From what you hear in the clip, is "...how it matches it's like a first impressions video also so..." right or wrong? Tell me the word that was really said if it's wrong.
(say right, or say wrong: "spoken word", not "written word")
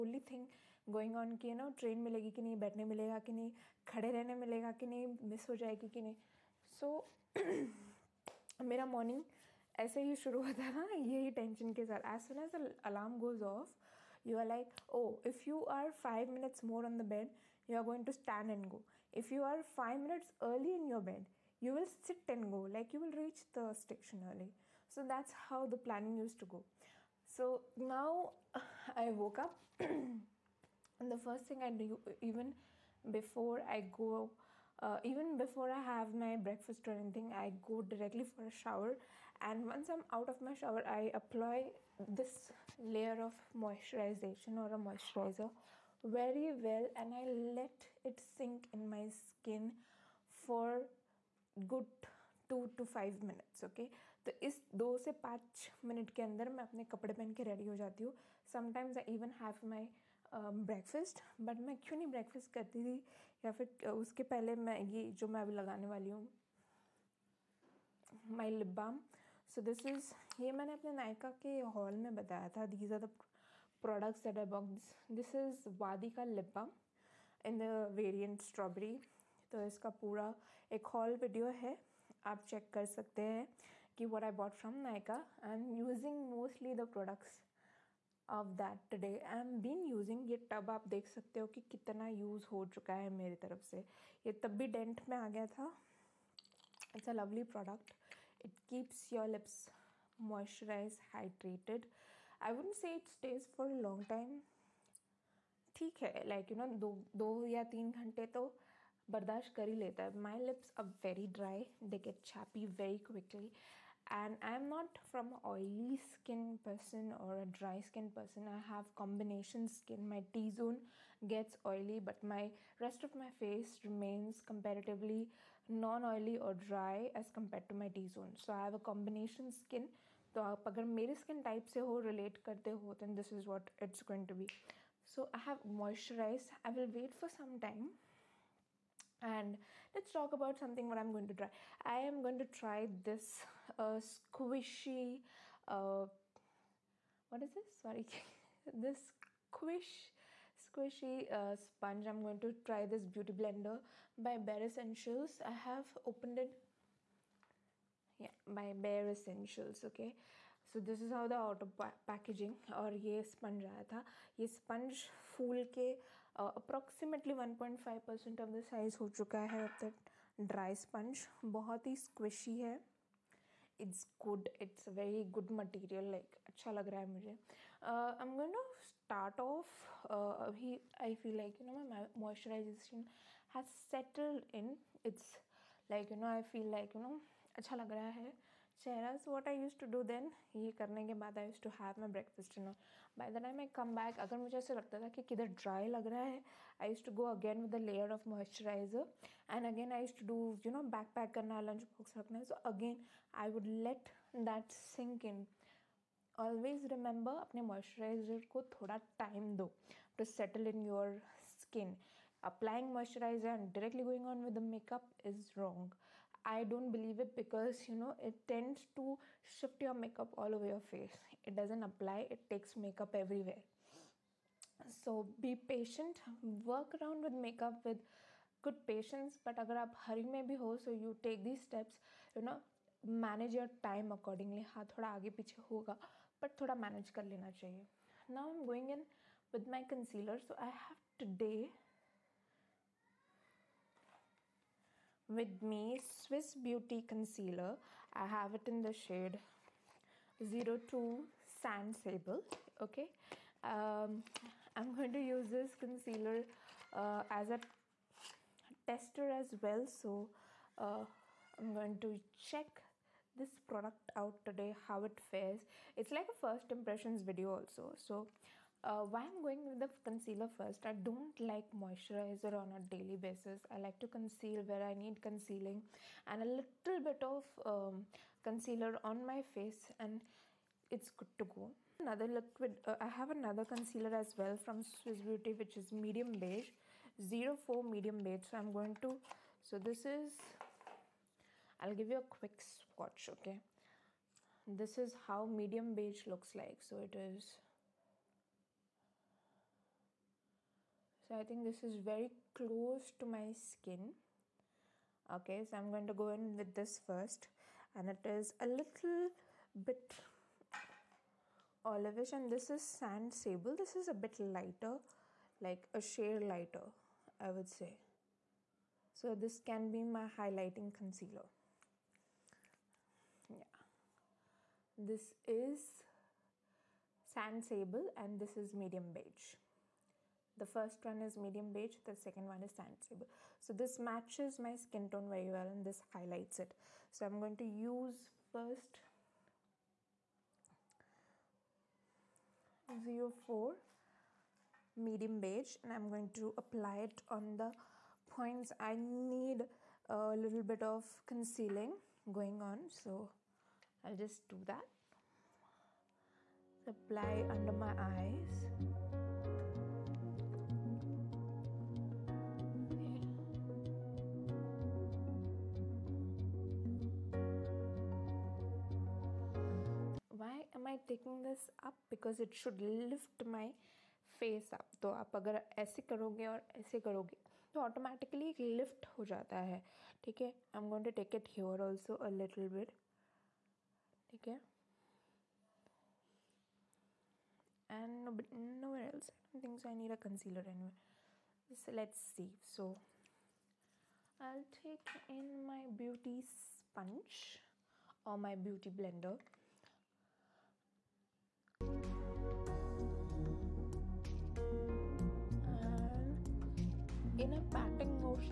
wrong: "fares", not "matches".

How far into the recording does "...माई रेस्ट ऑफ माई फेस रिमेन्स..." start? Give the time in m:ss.
2:02.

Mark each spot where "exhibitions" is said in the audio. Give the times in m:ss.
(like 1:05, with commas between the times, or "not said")
not said.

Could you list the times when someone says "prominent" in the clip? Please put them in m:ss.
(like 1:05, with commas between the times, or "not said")
not said.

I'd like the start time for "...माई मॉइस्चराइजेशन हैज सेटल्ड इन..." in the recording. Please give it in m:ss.
3:01.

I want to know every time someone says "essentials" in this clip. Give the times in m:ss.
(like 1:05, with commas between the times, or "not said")
2:34, 2:39.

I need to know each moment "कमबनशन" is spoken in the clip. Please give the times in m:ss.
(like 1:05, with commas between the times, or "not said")
1:58, 2:08.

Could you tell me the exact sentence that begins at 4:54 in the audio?
This is how medium beige looks like.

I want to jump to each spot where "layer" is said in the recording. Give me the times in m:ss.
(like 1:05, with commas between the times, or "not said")
0:42.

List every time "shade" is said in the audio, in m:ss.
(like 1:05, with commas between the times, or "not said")
4:08, 5:16.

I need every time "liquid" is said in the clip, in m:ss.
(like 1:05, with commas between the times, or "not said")
4:42.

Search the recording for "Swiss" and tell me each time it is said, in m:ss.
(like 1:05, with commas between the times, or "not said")
4:05, 4:44.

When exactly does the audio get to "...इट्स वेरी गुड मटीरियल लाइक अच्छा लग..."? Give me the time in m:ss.
2:54.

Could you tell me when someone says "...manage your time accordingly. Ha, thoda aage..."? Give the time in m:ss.
3:53.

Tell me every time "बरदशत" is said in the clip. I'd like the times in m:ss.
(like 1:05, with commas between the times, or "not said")
1:49.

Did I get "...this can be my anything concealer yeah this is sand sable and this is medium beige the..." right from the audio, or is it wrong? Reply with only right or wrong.
wrong.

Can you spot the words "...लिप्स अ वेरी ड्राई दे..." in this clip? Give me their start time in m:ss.
1:50.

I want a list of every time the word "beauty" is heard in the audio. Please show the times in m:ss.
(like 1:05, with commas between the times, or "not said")
2:33, 4:06, 4:45.